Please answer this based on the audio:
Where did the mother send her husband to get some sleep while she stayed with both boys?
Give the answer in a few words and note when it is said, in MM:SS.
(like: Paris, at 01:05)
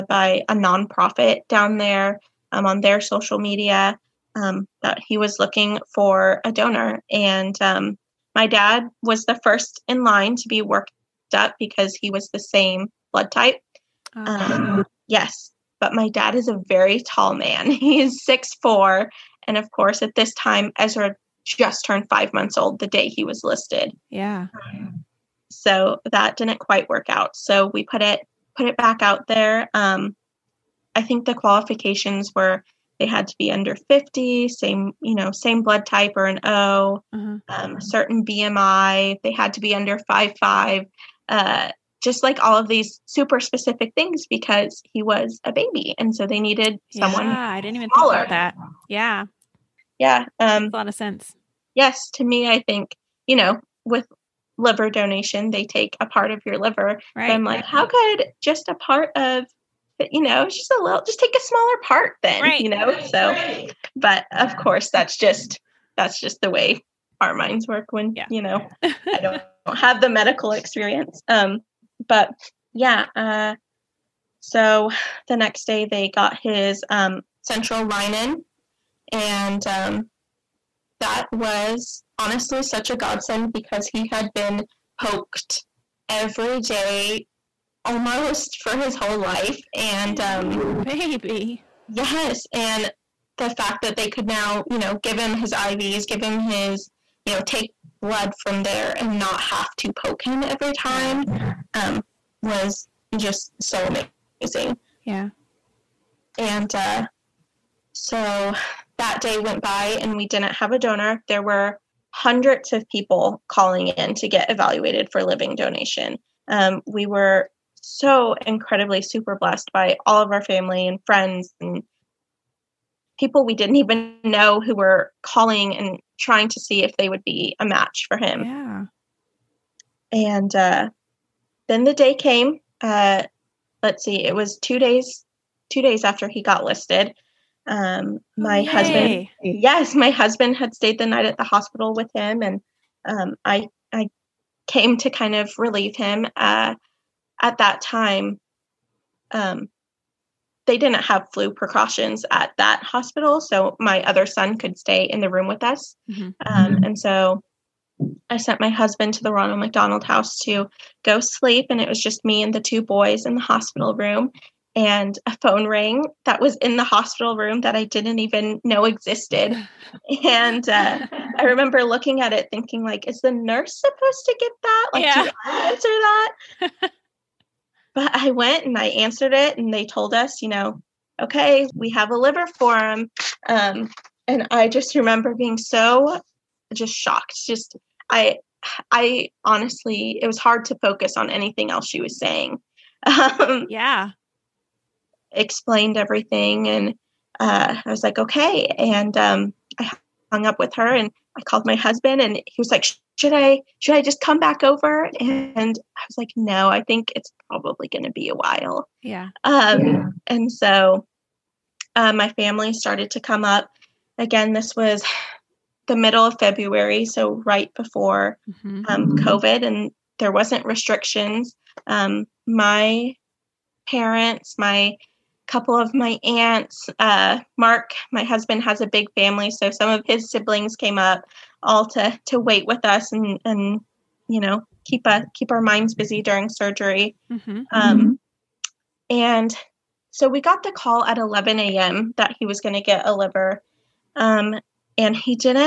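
Ronald McDonald House, at 02:39.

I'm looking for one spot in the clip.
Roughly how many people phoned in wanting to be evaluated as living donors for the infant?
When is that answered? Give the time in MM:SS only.
01:52.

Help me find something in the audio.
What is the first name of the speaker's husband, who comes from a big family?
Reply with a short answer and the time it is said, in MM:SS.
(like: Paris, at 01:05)
Mark, at 03:47.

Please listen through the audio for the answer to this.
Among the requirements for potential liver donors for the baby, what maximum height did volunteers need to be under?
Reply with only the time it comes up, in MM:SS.
00:40.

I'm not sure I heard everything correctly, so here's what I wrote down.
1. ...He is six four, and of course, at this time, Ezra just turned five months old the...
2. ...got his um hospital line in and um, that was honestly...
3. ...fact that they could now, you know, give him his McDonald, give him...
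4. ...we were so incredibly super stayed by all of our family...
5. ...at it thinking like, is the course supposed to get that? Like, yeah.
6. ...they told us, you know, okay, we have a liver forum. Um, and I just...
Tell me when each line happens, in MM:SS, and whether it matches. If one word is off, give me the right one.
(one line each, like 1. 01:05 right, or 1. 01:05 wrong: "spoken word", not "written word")
1. 00:17 right
2. 01:16 wrong: "central", not "hospital"
3. 01:33 wrong: "IVs", not "McDonald"
4. 01:56 wrong: "blessed", not "stayed"
5. 02:52 wrong: "nurse", not "course"
6. 02:59 right.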